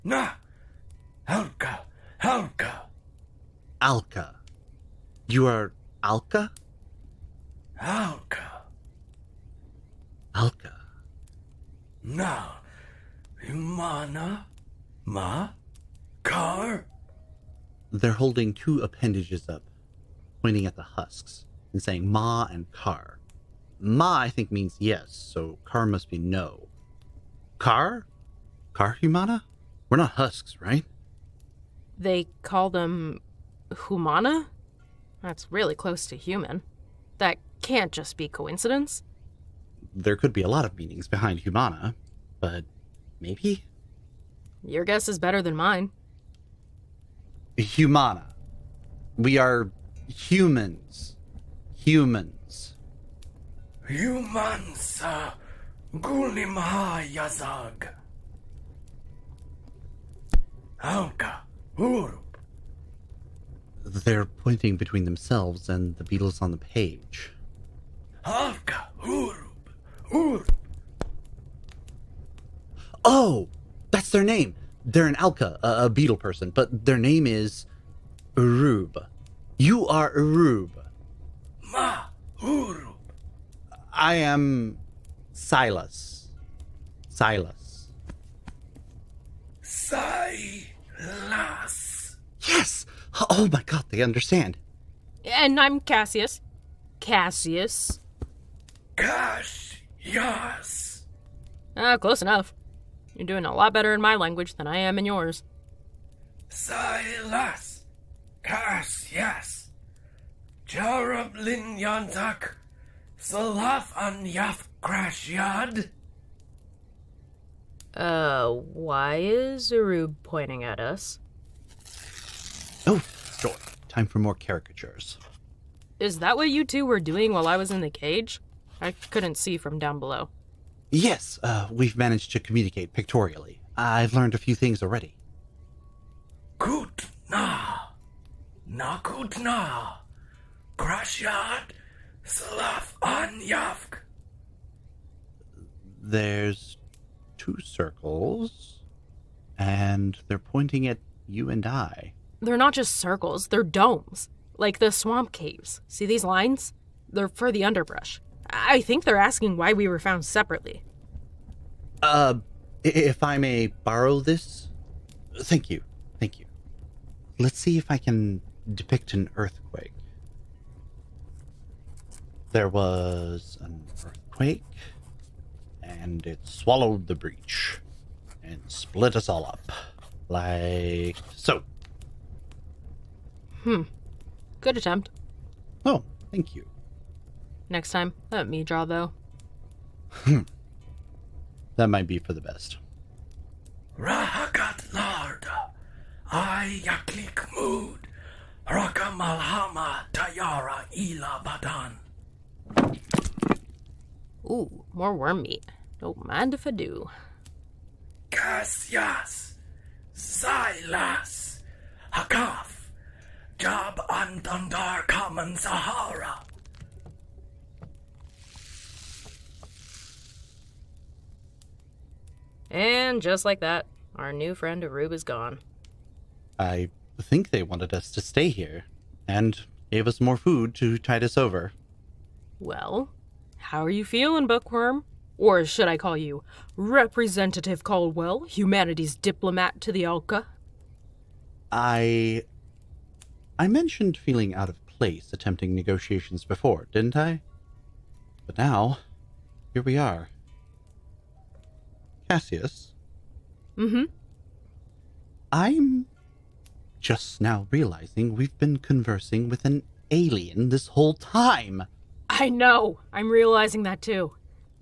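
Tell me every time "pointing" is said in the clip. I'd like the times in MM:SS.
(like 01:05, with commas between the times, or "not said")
00:20, 01:04, 02:00, 02:30.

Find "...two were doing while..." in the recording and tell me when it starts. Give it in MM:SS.
02:06.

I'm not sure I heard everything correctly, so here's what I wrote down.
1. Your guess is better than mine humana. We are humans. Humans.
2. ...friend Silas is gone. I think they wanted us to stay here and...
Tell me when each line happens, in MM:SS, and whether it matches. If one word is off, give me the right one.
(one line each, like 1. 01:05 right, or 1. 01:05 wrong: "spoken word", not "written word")
1. 00:44 right
2. 03:44 wrong: "Arub", not "Silas".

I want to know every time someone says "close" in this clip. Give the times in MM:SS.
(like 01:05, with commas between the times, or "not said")
00:35, 01:41.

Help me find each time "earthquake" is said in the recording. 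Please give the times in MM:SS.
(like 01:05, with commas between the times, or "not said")
02:49, 02:54.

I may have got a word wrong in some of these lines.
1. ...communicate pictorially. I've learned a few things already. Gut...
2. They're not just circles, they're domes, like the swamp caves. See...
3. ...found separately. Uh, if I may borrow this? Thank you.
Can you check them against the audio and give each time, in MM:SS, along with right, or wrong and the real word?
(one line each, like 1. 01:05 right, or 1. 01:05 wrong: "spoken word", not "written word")
1. 02:12 right
2. 02:32 right
3. 02:39 right.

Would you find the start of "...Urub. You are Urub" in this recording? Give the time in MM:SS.
01:18.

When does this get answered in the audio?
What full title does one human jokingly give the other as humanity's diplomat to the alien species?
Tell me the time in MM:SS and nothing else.
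03:56.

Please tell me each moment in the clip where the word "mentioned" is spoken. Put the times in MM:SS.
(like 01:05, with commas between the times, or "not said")
04:03.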